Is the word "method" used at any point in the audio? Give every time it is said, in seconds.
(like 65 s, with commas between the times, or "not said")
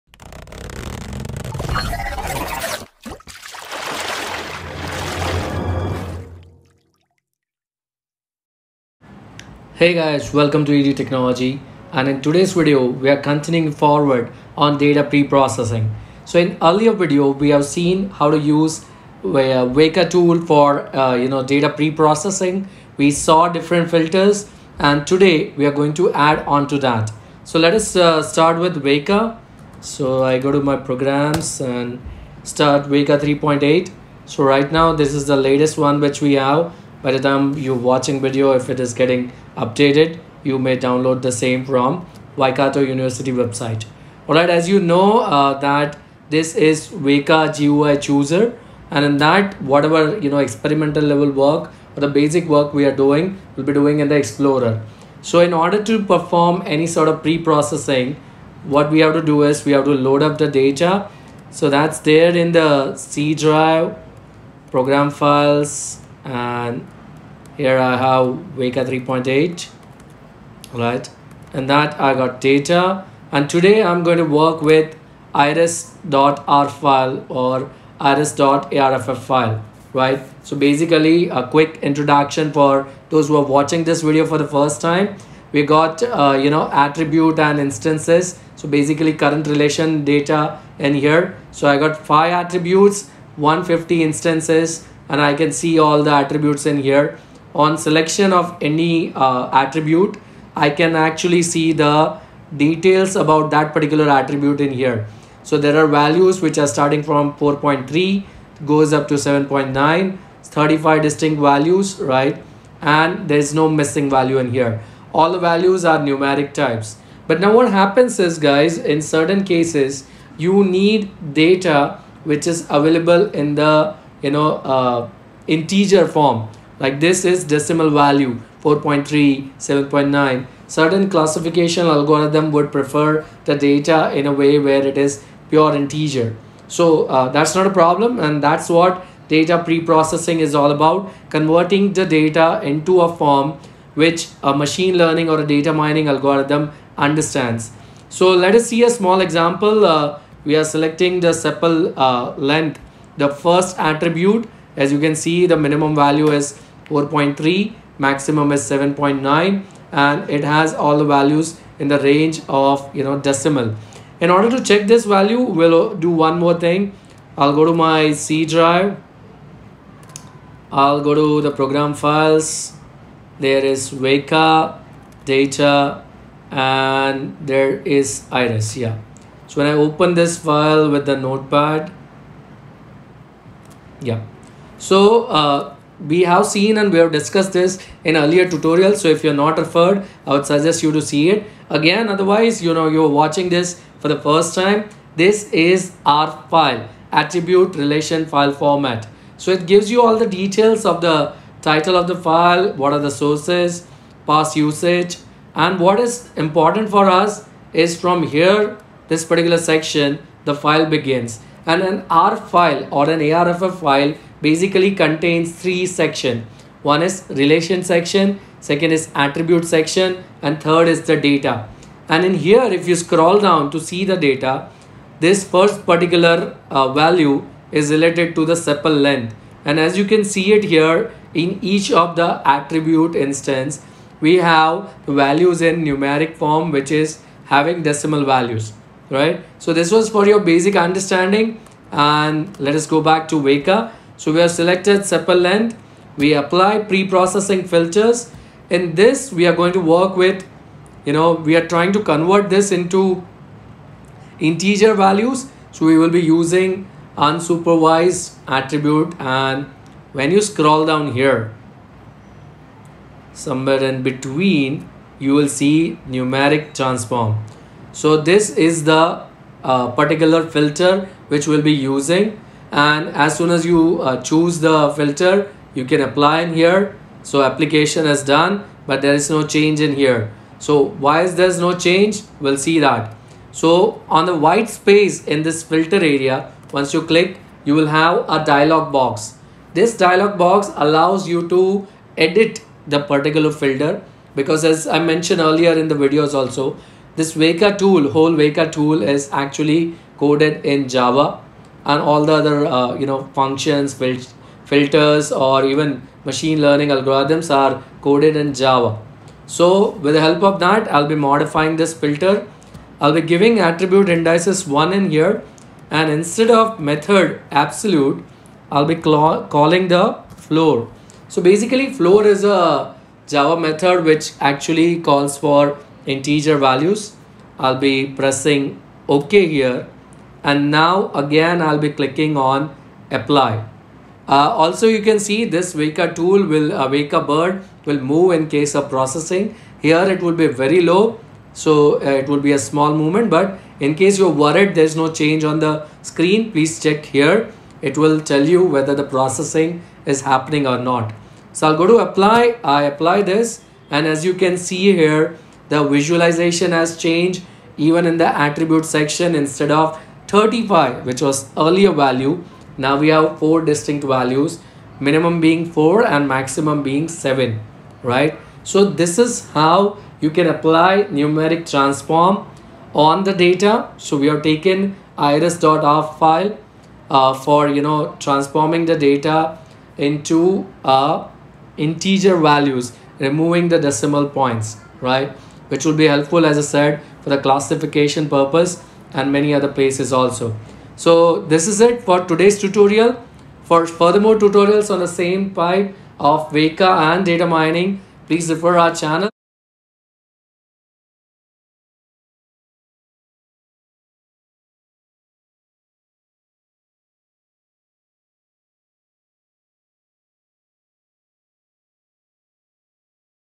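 316 s, 323 s.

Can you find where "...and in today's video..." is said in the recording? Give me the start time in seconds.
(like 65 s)
11 s.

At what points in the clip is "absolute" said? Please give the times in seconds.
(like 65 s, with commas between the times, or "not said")
317 s.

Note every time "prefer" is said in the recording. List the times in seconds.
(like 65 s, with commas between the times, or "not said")
132 s.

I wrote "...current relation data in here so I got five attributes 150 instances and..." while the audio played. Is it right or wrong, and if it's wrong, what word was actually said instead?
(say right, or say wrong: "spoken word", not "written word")
right.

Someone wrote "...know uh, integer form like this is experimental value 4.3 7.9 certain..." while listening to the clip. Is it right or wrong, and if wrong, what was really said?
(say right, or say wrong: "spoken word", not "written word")
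wrong: "decimal", not "experimental".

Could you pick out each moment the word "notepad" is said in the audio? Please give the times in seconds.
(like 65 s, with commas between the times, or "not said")
181 s.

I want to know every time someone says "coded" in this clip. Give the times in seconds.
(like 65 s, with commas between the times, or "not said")
300 s, 308 s.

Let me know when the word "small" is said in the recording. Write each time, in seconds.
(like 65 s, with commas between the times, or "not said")
148 s, 342 s.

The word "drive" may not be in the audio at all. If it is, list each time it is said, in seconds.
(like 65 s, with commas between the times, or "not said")
63 s, 168 s.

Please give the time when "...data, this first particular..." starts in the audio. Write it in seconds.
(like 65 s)
224 s.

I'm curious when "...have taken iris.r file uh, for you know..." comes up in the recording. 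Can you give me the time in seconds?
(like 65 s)
374 s.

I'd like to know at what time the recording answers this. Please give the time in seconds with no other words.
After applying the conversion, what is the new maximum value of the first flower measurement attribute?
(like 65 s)
366 s.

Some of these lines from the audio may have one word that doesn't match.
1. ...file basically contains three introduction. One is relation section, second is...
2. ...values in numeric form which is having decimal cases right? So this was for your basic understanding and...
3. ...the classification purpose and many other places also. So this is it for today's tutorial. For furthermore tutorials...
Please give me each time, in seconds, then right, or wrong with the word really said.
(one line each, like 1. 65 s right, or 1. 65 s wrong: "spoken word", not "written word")
1. 213 s wrong: "section", not "introduction"
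2. 235 s wrong: "values", not "cases"
3. 387 s right.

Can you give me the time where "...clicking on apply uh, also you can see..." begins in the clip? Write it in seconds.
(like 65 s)
331 s.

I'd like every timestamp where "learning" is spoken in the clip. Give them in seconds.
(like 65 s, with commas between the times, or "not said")
144 s, 306 s.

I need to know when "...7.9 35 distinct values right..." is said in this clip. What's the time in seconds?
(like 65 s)
109 s.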